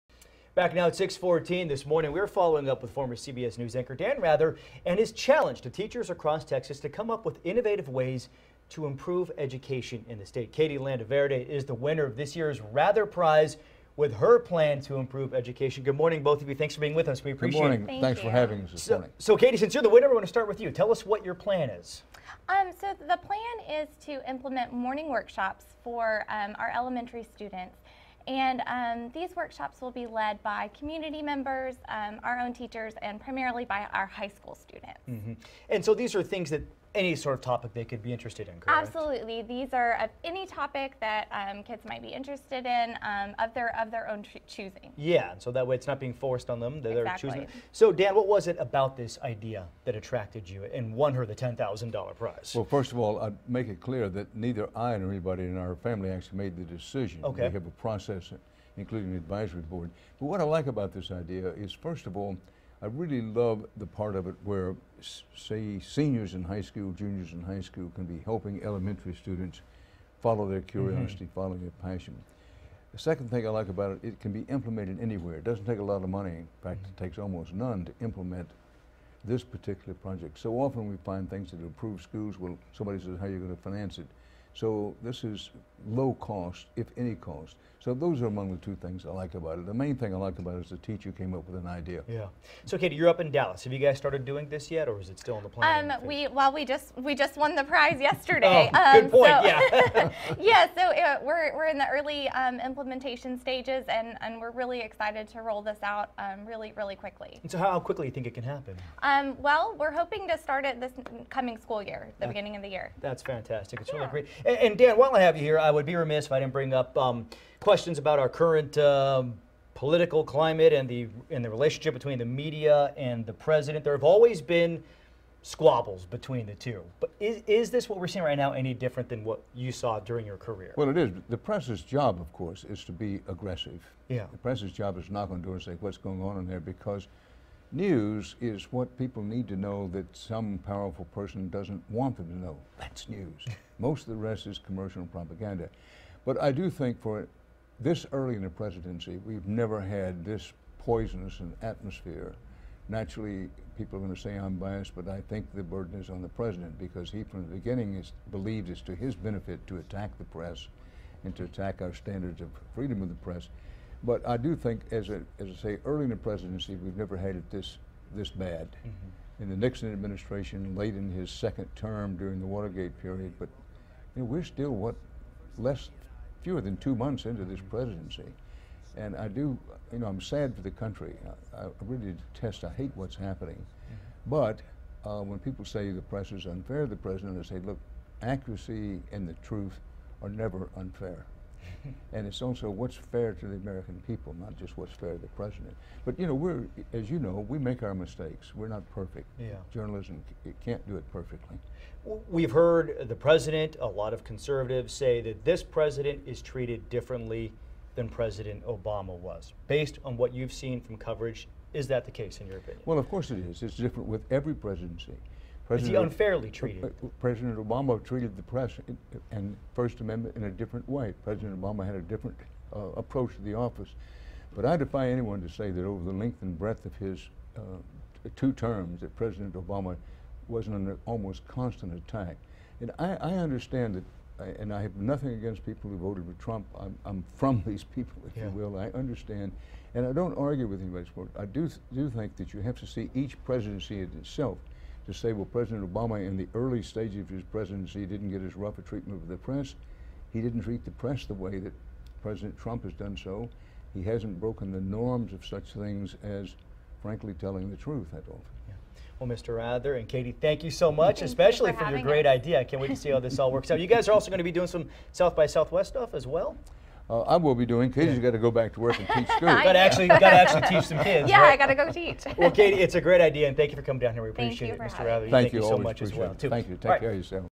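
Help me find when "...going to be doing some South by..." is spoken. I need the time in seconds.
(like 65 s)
264 s.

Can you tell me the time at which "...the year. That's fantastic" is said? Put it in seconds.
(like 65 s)
112 s.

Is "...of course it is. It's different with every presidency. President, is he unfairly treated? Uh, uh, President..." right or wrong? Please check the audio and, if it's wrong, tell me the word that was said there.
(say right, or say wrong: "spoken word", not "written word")
right.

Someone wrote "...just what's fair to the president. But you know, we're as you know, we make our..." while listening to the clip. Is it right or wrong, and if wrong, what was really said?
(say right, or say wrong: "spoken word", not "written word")
right.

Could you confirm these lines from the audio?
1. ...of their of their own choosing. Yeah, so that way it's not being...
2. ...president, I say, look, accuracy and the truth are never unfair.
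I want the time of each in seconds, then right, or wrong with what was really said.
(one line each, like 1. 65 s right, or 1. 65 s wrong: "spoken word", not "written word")
1. 43 s right
2. 187 s right.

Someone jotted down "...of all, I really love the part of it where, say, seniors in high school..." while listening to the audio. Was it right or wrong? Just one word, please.
right.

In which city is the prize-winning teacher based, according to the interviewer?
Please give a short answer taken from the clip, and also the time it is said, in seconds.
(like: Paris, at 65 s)
Dallas, at 93 s.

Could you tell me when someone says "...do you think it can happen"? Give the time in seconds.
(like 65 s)
108 s.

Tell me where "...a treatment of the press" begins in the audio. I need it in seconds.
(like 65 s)
248 s.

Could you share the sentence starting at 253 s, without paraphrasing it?
He hasn't broken the norms of such things as, frankly, telling the truth, don't.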